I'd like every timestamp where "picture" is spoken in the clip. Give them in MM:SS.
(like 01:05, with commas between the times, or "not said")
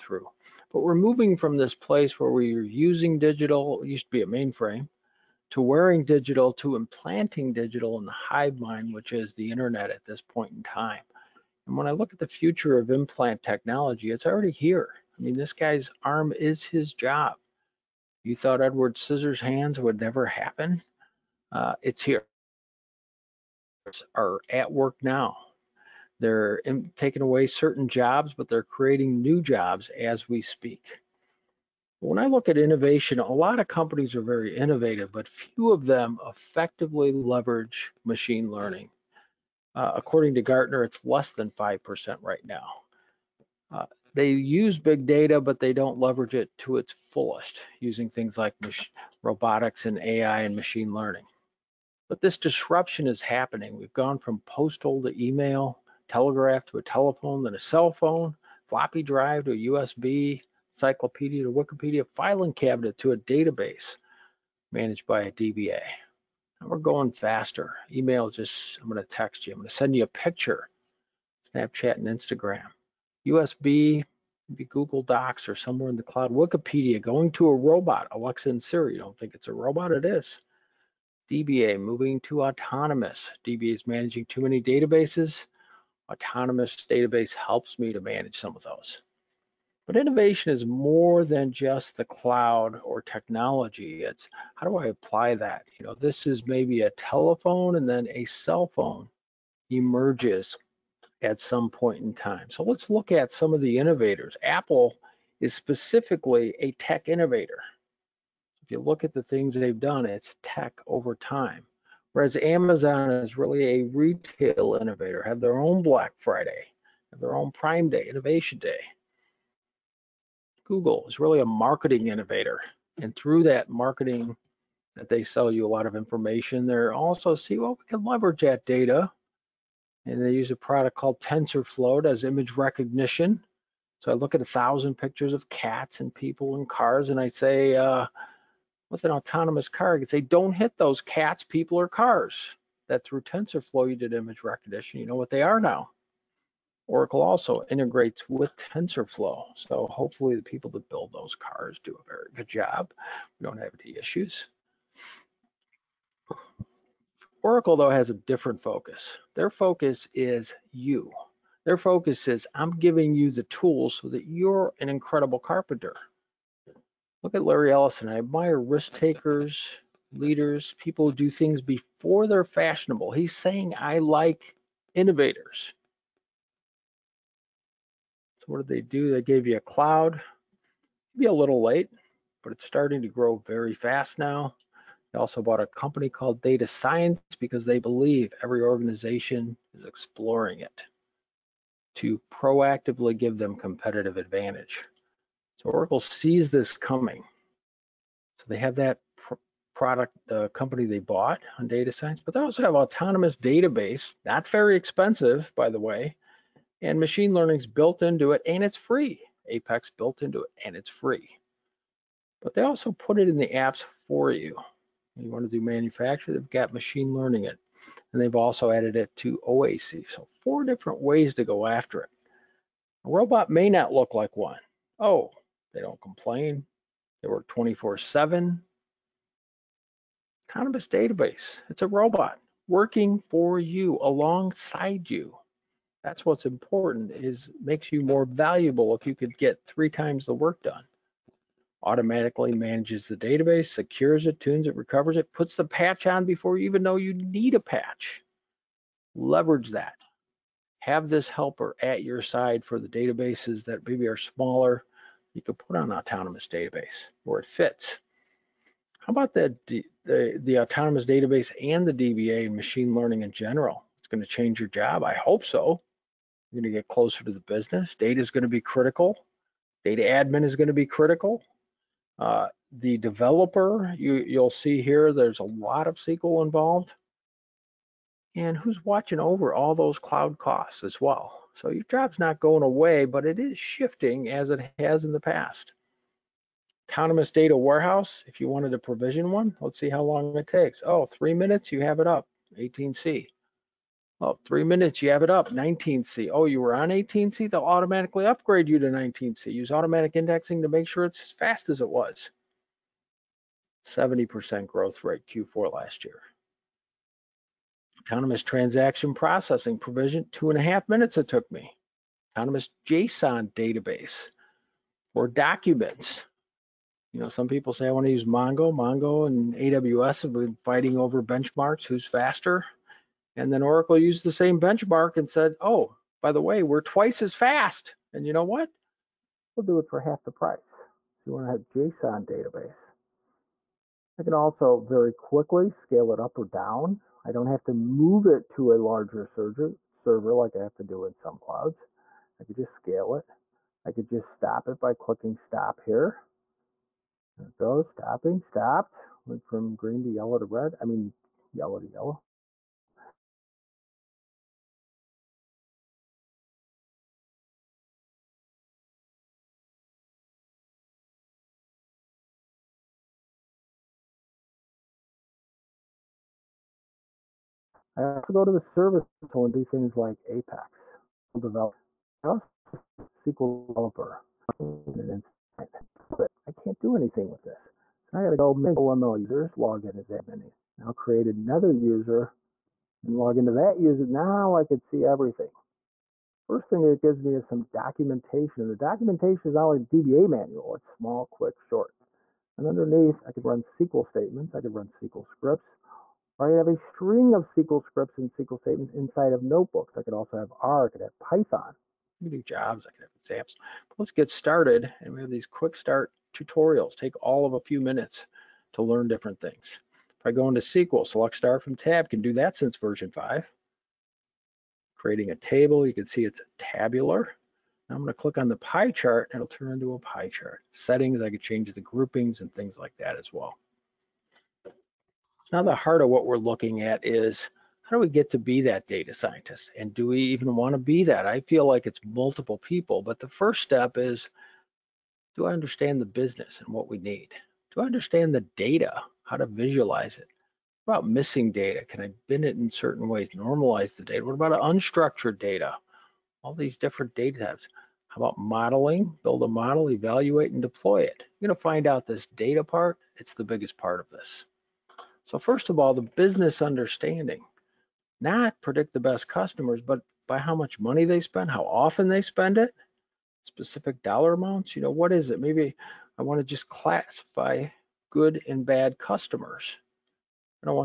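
01:10, 02:14.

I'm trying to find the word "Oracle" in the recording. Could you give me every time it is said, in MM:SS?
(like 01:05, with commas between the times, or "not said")
02:26, 02:37, 03:15, 05:23.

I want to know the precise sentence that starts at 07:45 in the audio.
Maybe I wanna just classify good and bad customers.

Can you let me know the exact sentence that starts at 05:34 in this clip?
I can also very quickly scale it up or down.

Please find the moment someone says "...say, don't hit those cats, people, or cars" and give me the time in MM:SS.
02:20.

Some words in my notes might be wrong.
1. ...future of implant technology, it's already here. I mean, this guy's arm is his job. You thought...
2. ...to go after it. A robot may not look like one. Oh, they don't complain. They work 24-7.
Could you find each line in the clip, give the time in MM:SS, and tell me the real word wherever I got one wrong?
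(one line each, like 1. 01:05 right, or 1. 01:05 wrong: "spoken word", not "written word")
1. 00:12 right
2. 03:41 right.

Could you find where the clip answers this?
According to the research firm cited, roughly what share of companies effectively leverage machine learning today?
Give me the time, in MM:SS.
00:41.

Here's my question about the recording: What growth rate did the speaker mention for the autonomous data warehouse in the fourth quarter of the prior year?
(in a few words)
70%.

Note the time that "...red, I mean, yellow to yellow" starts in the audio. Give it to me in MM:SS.
05:50.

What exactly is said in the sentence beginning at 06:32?
And underneath, I can run SQL statements.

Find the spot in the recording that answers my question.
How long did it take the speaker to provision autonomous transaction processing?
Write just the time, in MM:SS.
05:10.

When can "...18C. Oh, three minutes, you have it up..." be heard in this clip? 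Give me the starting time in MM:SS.
04:52.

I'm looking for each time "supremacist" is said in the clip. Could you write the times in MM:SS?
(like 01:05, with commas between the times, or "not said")
not said.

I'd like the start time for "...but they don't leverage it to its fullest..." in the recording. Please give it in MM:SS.
00:45.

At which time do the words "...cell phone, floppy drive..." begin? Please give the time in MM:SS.
00:57.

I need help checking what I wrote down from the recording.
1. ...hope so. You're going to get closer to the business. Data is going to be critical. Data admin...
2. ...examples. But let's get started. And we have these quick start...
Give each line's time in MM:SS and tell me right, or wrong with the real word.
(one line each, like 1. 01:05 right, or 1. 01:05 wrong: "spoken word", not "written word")
1. 04:25 right
2. 06:43 right.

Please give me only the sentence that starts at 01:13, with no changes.
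USB, maybe Google Docs or somewhere in the cloud.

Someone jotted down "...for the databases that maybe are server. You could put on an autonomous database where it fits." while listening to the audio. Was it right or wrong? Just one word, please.
wrong.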